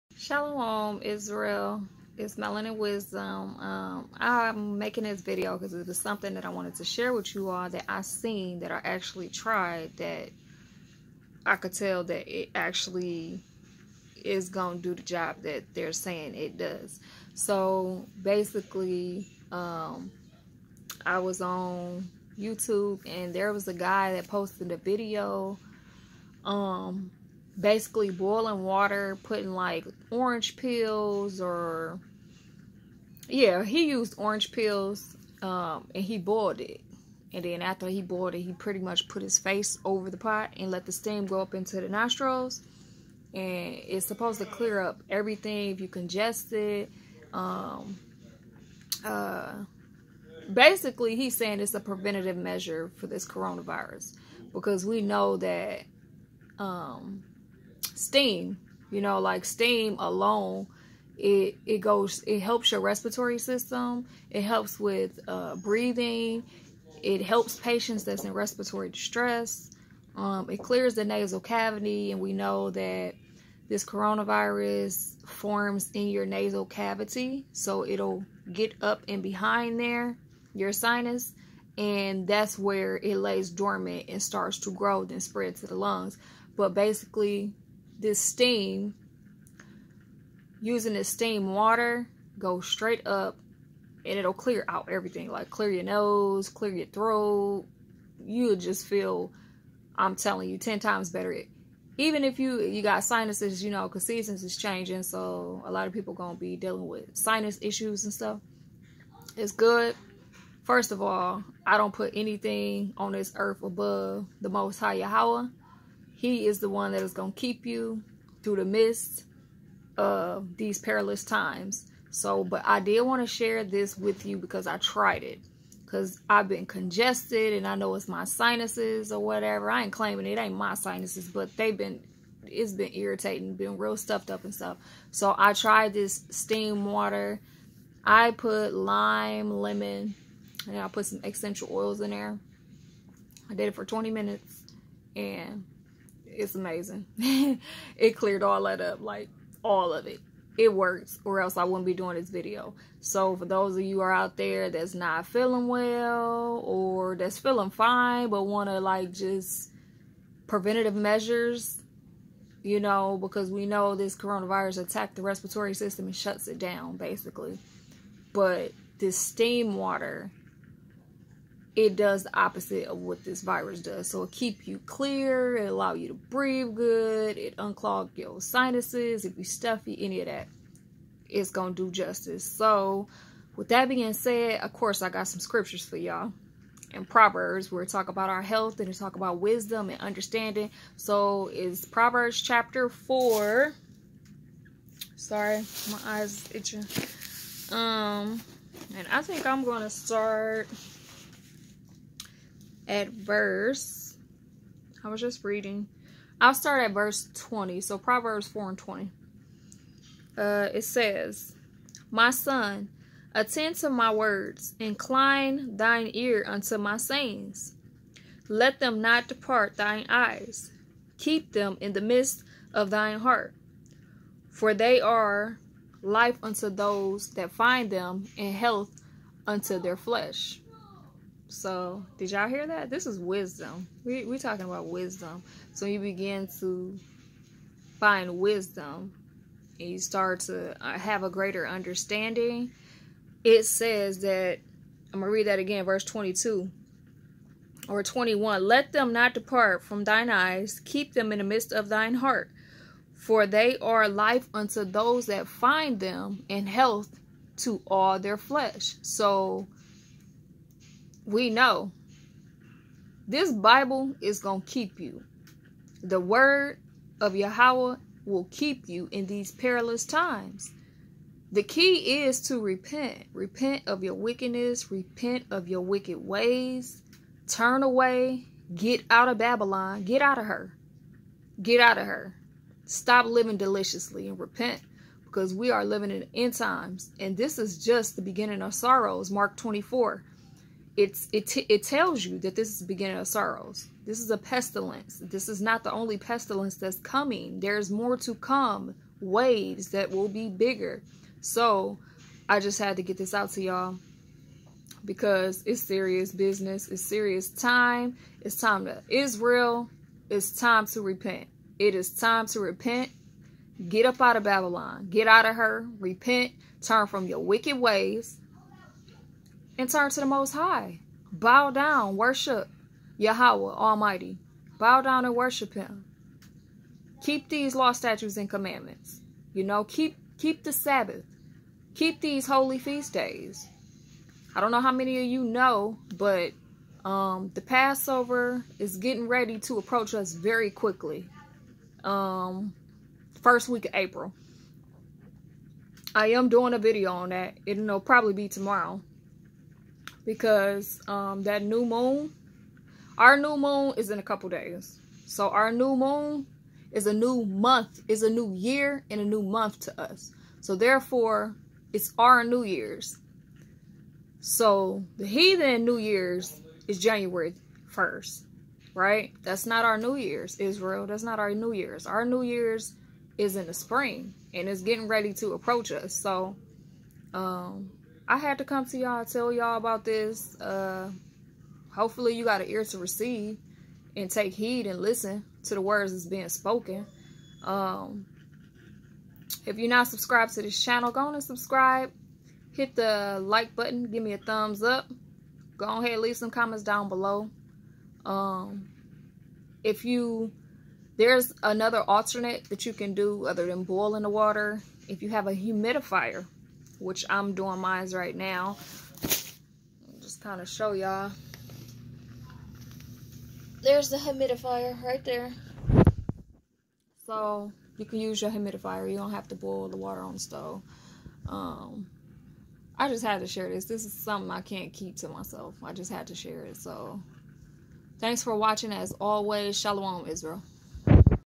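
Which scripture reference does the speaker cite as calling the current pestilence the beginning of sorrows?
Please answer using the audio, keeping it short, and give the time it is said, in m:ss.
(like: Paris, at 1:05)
Mark 24, at 4:49.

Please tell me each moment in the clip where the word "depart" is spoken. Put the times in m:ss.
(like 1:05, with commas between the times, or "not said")
3:39, 4:09.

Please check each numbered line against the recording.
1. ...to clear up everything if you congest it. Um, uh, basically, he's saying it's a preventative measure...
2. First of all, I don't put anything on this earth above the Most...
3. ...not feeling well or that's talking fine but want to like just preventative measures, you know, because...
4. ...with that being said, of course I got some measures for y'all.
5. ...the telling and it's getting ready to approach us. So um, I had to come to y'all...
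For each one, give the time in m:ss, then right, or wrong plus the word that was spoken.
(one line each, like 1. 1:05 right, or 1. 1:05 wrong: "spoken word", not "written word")
1. 0:44 right
2. 1:50 right
3. 2:34 wrong: "feeling", not "talking"
4. 3:03 wrong: "scriptures", not "measures"
5. 6:13 wrong: "spring", not "telling".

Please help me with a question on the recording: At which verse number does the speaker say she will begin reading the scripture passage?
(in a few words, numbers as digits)
20.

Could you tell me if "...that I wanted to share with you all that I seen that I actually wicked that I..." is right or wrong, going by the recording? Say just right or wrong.
wrong.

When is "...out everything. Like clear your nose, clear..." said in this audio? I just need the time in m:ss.
1:34.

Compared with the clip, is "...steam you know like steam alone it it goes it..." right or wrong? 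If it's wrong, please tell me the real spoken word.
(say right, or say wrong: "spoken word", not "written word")
right.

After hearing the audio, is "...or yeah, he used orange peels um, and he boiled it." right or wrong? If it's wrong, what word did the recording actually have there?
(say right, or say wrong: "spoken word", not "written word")
right.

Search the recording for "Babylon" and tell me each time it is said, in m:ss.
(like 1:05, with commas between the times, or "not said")
4:39, 5:14.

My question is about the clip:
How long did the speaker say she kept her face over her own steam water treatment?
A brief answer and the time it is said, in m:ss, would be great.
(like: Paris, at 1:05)
20 minutes, at 2:23.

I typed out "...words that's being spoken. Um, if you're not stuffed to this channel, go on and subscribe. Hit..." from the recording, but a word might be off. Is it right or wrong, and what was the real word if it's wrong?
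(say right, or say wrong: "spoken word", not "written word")
wrong: "subscribed", not "stuffed".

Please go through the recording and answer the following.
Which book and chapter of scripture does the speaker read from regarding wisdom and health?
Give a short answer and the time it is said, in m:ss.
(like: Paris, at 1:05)
Proverbs 4, at 3:11.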